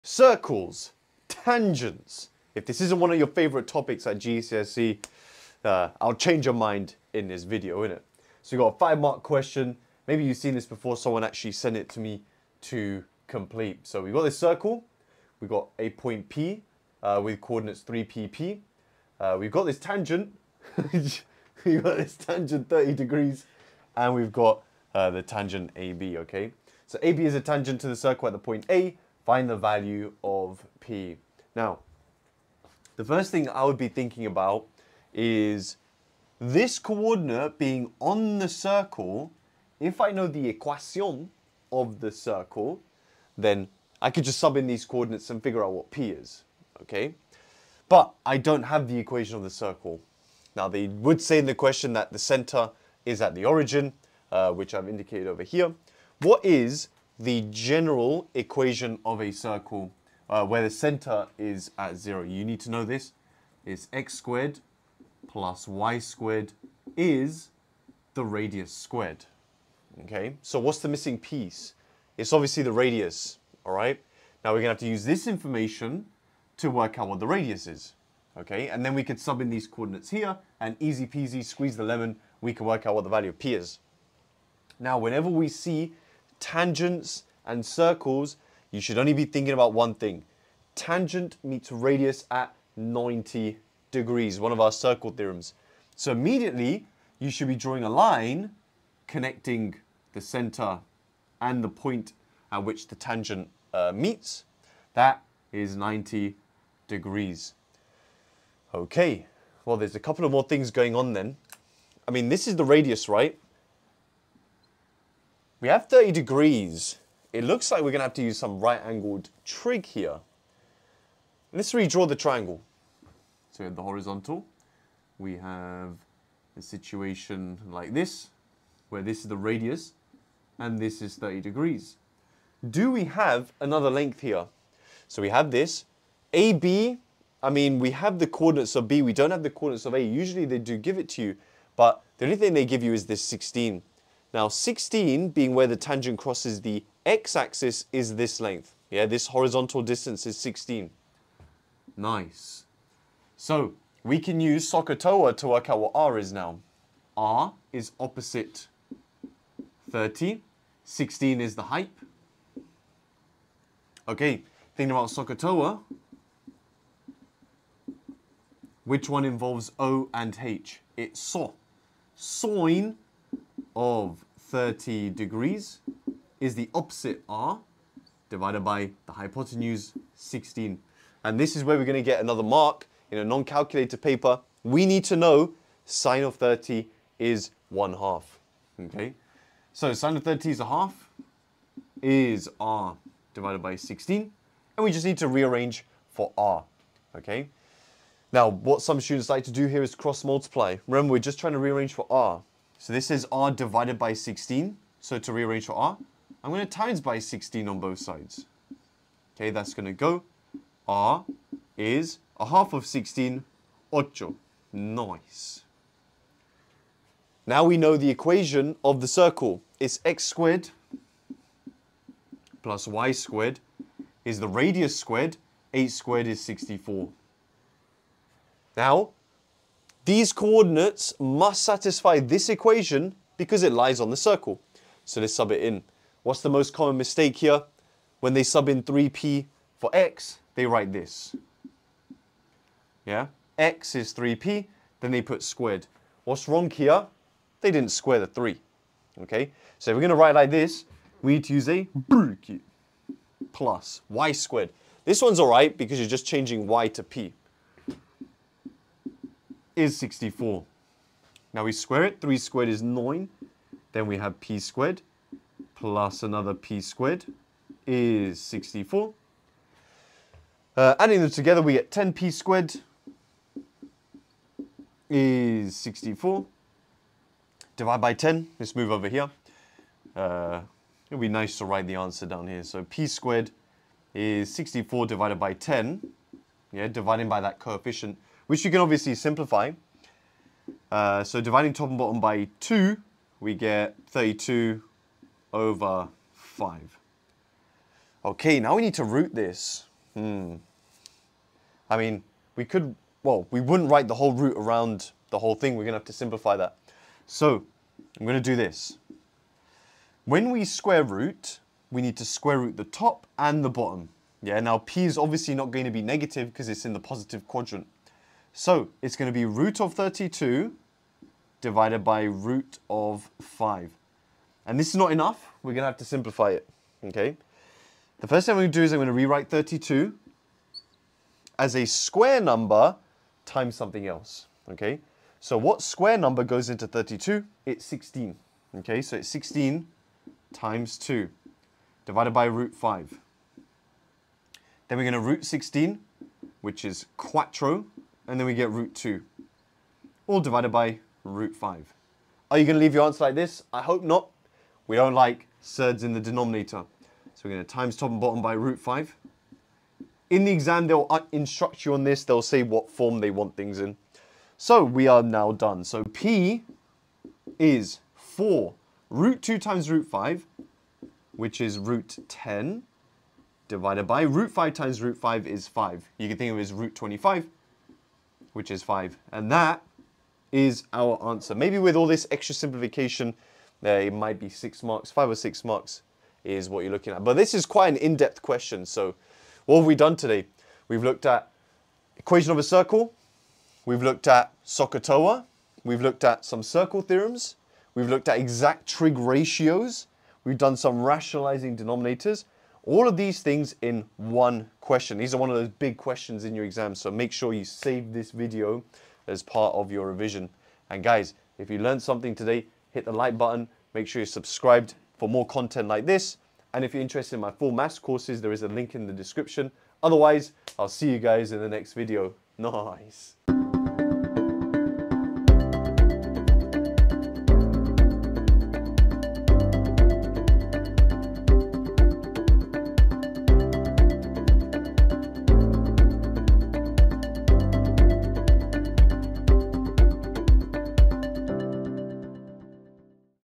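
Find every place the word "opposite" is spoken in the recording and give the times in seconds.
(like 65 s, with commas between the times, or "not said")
157 s, 176 s.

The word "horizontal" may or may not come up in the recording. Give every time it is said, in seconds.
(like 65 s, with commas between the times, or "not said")
123 s, 149 s.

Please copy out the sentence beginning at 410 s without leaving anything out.
And guys, if you learned something today, hit the like button, make sure you're subscribed for more content like this.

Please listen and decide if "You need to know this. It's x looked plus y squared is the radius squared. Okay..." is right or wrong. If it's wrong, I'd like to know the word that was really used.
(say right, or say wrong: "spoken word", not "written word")
wrong: "squared", not "looked".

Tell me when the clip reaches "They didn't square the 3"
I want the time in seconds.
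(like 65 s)
247 s.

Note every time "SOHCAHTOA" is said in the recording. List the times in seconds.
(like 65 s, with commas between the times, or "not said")
154 s, 165 s, 394 s.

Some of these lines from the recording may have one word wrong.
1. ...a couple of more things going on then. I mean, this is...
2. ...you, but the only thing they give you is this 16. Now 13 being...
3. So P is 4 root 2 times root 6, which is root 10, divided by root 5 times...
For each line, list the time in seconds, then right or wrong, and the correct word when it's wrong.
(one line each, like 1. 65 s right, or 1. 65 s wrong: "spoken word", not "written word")
1. 109 s right
2. 141 s wrong: "16", not "13"
3. 365 s wrong: "5", not "6".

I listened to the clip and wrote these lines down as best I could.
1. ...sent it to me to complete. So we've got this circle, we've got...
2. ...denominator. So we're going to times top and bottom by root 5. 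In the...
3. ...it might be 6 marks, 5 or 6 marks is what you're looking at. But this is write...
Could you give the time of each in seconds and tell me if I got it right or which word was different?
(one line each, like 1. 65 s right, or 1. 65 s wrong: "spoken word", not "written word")
1. 11 s right
2. 356 s right
3. 383 s wrong: "quite", not "write".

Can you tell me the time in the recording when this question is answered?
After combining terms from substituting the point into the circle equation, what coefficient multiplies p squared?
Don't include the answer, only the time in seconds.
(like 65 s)
271 s.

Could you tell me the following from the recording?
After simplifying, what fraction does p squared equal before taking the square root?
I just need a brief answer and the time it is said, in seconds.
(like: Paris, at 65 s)
32/5, at 294 s.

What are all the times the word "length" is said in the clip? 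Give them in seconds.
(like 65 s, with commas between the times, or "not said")
133 s, 148 s.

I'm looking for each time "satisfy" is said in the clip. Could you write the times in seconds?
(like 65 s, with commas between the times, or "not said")
231 s.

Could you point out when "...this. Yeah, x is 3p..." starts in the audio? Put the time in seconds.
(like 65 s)
240 s.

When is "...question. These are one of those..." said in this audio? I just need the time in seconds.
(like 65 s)
404 s.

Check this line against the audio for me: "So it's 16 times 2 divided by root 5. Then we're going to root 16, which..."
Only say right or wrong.
right.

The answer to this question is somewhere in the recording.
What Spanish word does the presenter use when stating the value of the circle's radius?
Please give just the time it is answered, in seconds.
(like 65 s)
213 s.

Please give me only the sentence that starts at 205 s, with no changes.
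So to rearrange for r, I'm going to times by 16 on both sides.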